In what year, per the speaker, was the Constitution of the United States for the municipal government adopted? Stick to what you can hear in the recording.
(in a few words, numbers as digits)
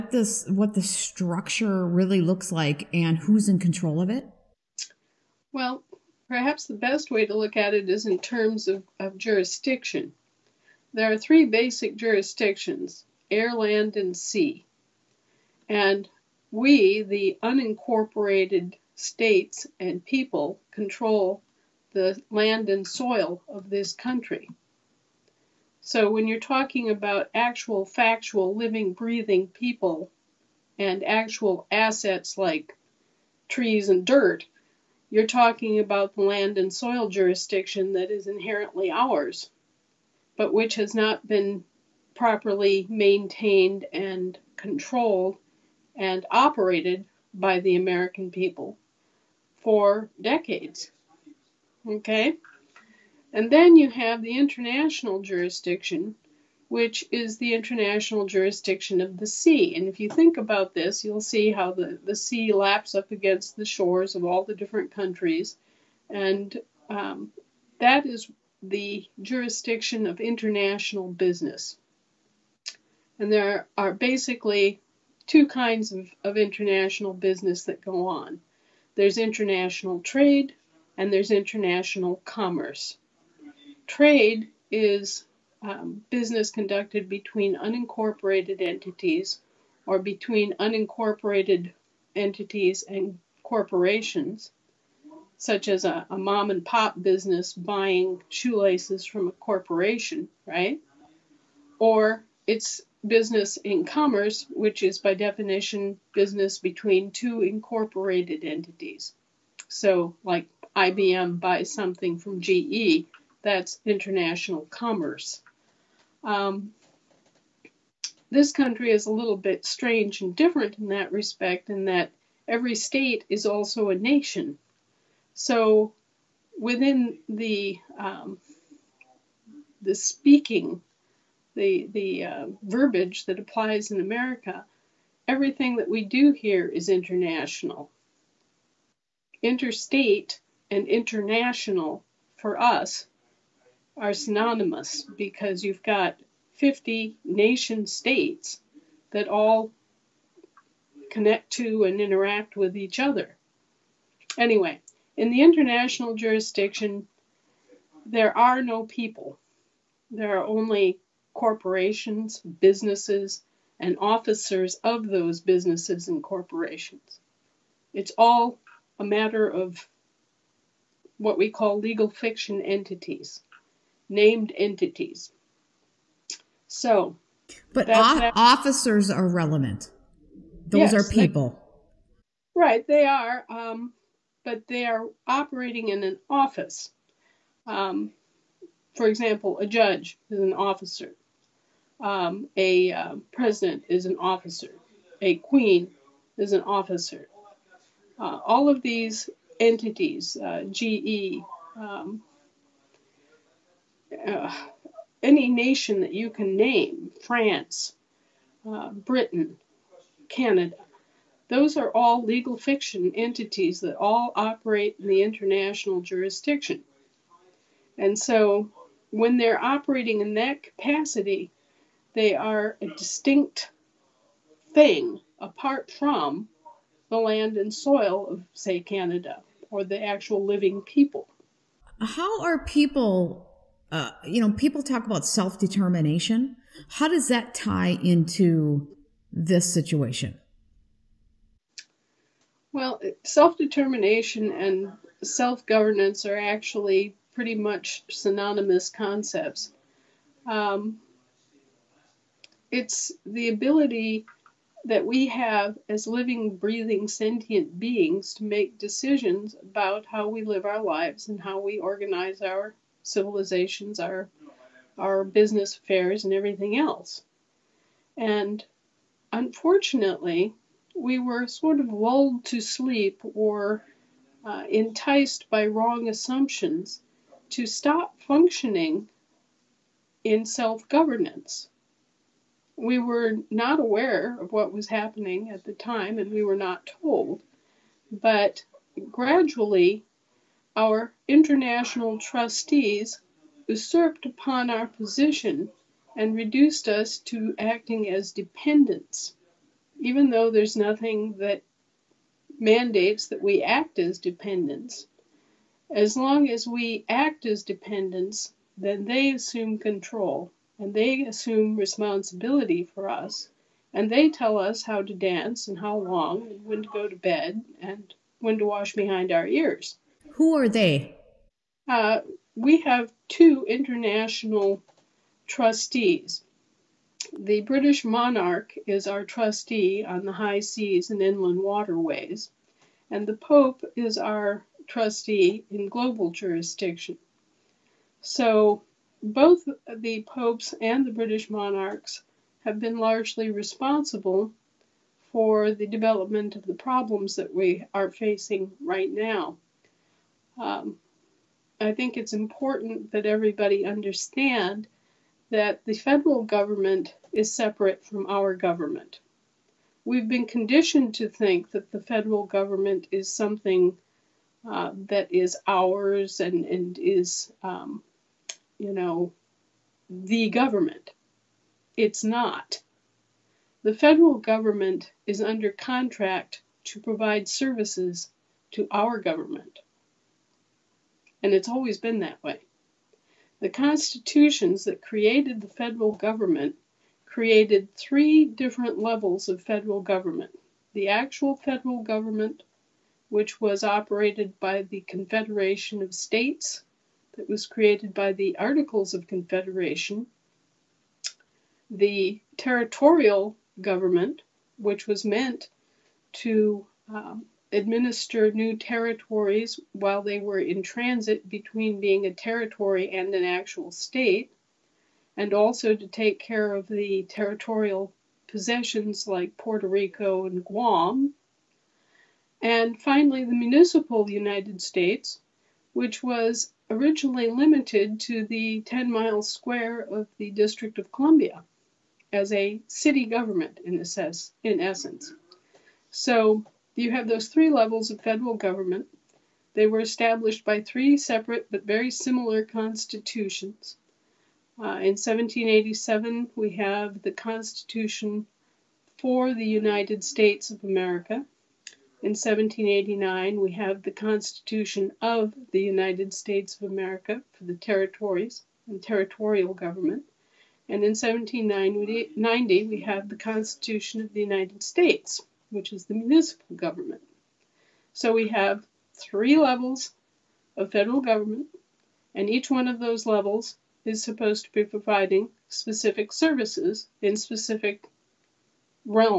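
1790.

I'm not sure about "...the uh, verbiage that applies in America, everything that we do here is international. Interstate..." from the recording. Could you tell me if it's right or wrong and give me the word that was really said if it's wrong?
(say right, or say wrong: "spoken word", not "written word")
right.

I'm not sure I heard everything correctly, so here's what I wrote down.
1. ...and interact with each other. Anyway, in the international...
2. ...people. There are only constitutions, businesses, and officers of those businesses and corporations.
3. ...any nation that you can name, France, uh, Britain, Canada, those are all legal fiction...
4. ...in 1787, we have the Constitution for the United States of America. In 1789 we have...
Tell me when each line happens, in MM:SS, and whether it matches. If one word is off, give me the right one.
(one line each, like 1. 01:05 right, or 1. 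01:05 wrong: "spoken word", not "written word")
1. 02:31 right
2. 02:38 wrong: "corporations", not "constitutions"
3. 03:25 right
4. 07:25 right.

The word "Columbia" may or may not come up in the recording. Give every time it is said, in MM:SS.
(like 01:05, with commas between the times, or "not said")
07:11.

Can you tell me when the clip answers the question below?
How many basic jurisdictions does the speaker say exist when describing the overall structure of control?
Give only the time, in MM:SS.
00:11.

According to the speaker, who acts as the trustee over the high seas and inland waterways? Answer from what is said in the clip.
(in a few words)
The British monarch.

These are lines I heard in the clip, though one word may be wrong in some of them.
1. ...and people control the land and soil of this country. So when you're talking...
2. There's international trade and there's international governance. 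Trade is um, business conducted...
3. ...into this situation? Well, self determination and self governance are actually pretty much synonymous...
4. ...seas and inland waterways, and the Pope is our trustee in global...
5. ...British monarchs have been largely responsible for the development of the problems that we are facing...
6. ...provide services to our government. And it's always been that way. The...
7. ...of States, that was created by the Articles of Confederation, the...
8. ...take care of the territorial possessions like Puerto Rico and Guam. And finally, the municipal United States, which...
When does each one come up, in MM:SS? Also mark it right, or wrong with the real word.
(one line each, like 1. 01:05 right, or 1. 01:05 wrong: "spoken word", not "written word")
1. 00:19 right
2. 01:18 wrong: "commerce", not "governance"
3. 03:58 right
4. 05:30 right
5. 05:41 right
6. 06:17 right
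7. 06:36 right
8. 06:56 right.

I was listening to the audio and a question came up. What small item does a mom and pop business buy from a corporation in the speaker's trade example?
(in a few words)
Shoelaces.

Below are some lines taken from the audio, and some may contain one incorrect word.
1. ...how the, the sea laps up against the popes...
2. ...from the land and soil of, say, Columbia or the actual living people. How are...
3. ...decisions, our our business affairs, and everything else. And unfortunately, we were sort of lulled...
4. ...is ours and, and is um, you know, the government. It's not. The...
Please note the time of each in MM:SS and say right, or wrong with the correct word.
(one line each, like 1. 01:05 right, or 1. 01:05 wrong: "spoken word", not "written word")
1. 01:01 wrong: "shores", not "popes"
2. 03:45 wrong: "Canada", not "Columbia"
3. 04:23 wrong: "civilizations", not "decisions"
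4. 06:05 right.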